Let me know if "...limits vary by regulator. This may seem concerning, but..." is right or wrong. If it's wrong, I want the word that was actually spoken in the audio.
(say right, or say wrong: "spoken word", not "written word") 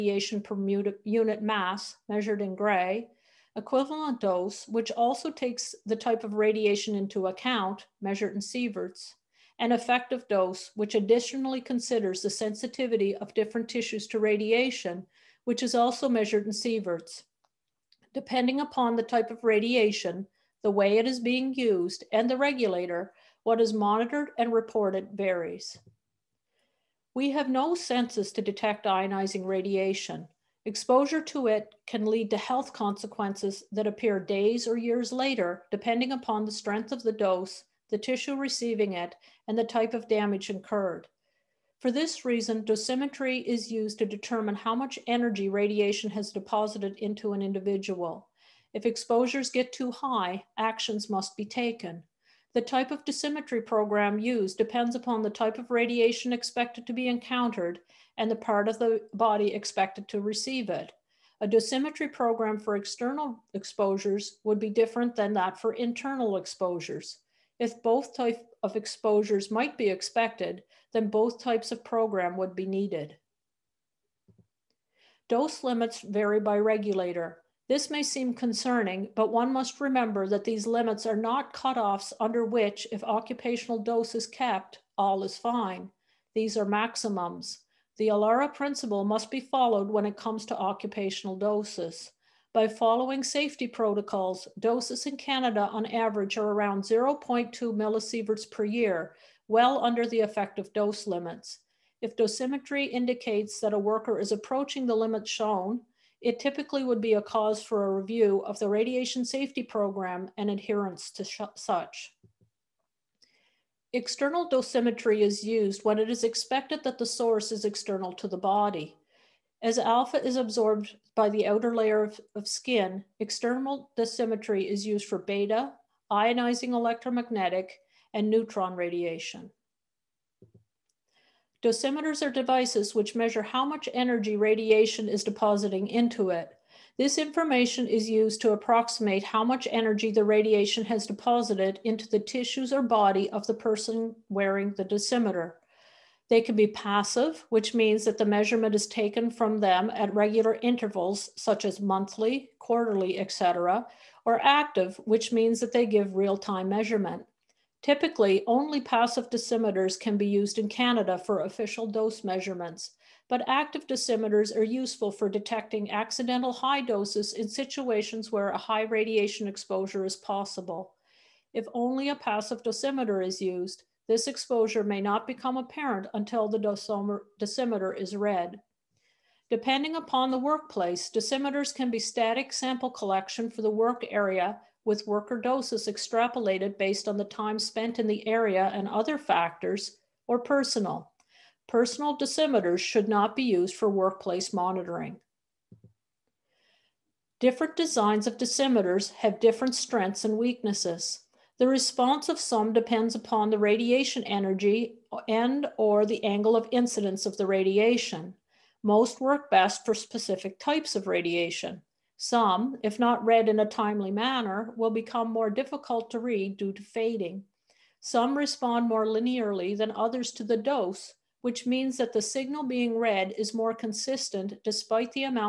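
right.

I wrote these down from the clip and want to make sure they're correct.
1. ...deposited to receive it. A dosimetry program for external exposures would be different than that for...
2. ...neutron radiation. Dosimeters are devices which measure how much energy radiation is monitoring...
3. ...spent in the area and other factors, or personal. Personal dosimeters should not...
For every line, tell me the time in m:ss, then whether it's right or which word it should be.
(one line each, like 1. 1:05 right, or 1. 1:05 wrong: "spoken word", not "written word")
1. 0:59 wrong: "expected", not "deposited"
2. 2:08 wrong: "depositing", not "monitoring"
3. 3:07 right.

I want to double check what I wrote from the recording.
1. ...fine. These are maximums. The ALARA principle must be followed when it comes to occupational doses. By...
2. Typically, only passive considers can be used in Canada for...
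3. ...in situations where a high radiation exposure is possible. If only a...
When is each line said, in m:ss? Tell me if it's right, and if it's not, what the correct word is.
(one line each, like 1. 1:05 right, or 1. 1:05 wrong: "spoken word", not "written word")
1. 1:25 right
2. 2:37 wrong: "dosimeters", not "considers"
3. 2:47 right.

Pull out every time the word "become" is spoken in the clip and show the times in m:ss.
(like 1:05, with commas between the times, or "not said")
2:55, 3:34.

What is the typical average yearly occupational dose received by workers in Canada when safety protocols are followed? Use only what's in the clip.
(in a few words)
0.2 millisieverts per year.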